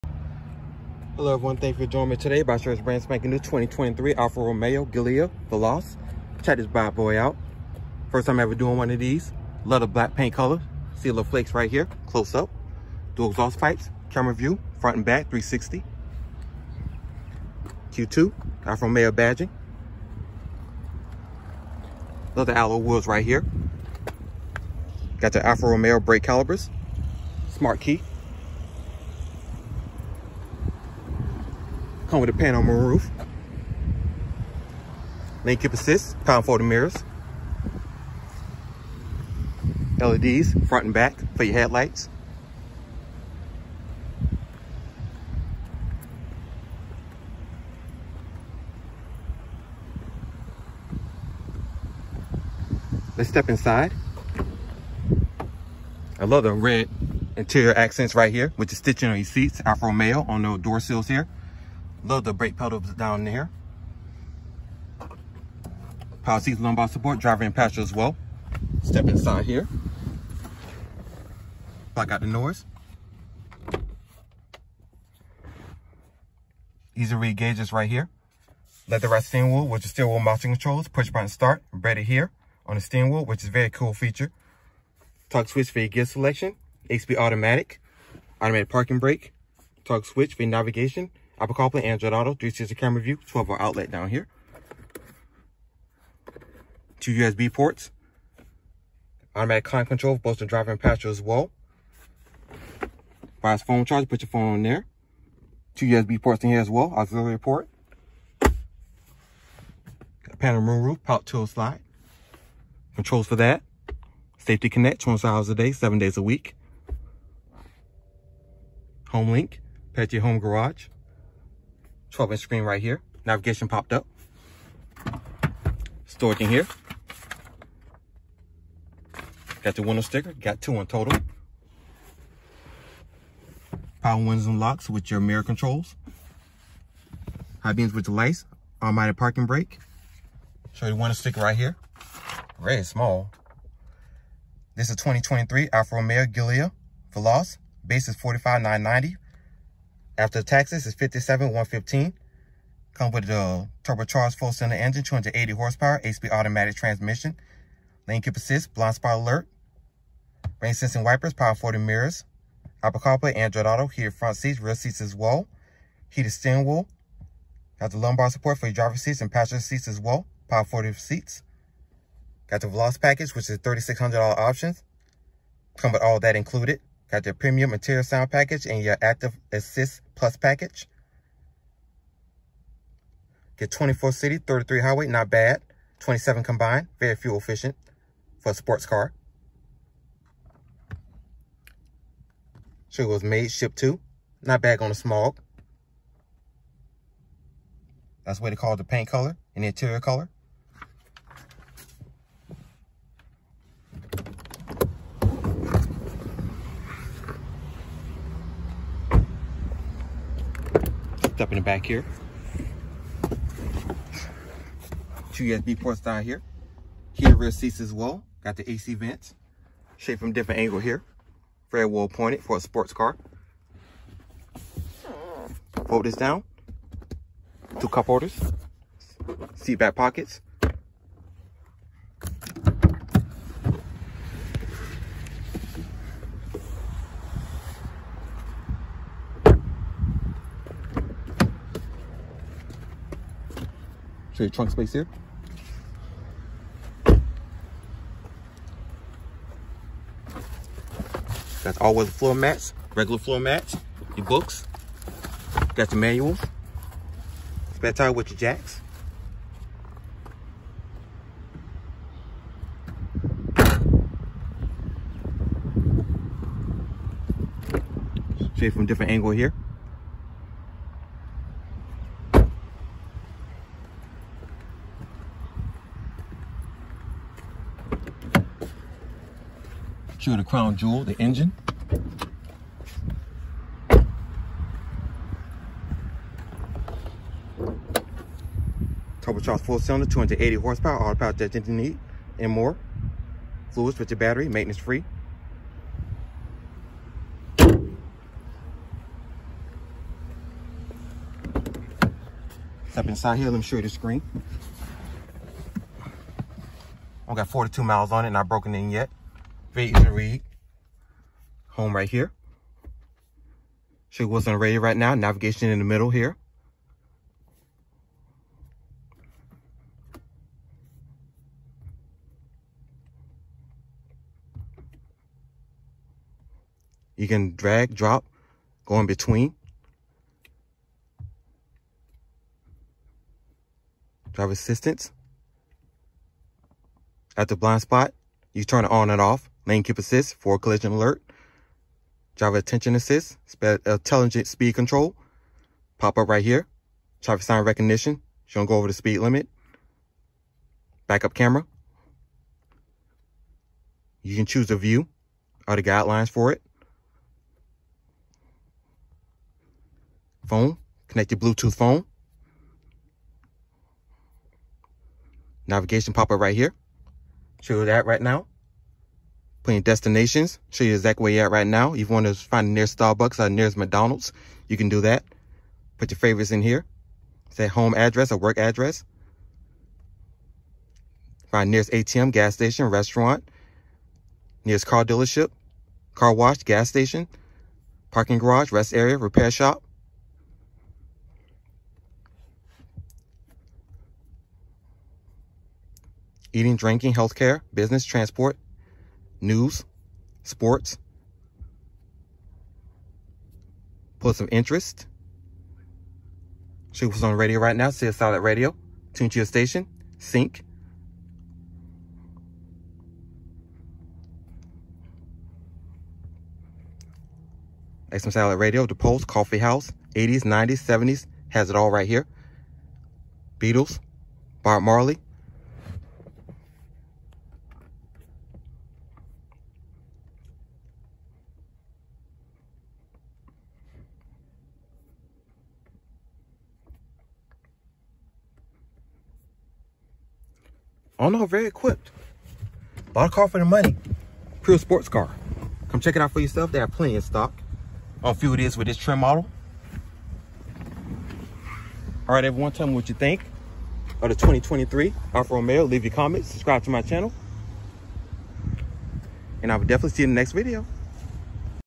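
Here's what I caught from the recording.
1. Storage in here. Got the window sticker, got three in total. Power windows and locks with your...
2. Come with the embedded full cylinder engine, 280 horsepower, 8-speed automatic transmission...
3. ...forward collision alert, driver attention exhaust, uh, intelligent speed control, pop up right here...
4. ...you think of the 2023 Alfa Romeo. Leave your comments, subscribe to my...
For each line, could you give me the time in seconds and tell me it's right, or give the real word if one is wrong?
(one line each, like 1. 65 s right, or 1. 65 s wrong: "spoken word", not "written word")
1. 126 s wrong: "two", not "three"
2. 152 s wrong: "turbocharged", not "embedded"
3. 340 s wrong: "assist", not "exhaust"
4. 453 s right.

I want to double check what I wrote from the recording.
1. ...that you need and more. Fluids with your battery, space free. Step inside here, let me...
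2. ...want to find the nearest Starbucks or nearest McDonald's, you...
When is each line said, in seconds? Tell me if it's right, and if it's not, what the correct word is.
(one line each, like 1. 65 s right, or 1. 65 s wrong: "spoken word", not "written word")
1. 291 s wrong: "maintenance", not "space"
2. 372 s right.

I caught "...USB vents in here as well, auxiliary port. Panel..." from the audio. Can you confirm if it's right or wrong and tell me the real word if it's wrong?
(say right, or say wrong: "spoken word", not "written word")
wrong: "ports", not "vents".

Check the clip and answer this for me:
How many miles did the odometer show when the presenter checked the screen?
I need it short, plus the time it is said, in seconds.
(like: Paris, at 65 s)
42, at 307 s.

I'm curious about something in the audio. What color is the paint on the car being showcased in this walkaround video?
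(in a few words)
Black.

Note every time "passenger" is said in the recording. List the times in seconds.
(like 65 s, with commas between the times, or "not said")
67 s, 100 s, 169 s.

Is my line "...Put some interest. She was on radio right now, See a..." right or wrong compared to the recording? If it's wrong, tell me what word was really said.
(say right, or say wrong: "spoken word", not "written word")
right.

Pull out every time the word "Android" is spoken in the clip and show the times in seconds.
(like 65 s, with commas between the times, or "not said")
91 s, 163 s.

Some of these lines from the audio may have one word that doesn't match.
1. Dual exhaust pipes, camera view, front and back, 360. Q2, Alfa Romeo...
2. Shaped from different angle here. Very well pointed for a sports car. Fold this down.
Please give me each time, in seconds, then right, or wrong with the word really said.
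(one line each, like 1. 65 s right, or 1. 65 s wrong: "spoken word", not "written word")
1. 13 s right
2. 219 s right.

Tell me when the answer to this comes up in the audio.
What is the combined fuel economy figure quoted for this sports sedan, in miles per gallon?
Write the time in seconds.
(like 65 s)
185 s.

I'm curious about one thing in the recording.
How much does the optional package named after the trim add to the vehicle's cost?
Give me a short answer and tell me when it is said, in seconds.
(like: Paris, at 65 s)
$3,600, at 173 s.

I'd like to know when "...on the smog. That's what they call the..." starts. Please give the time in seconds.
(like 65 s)
194 s.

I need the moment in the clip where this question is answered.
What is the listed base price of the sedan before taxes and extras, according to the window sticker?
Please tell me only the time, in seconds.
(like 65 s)
148 s.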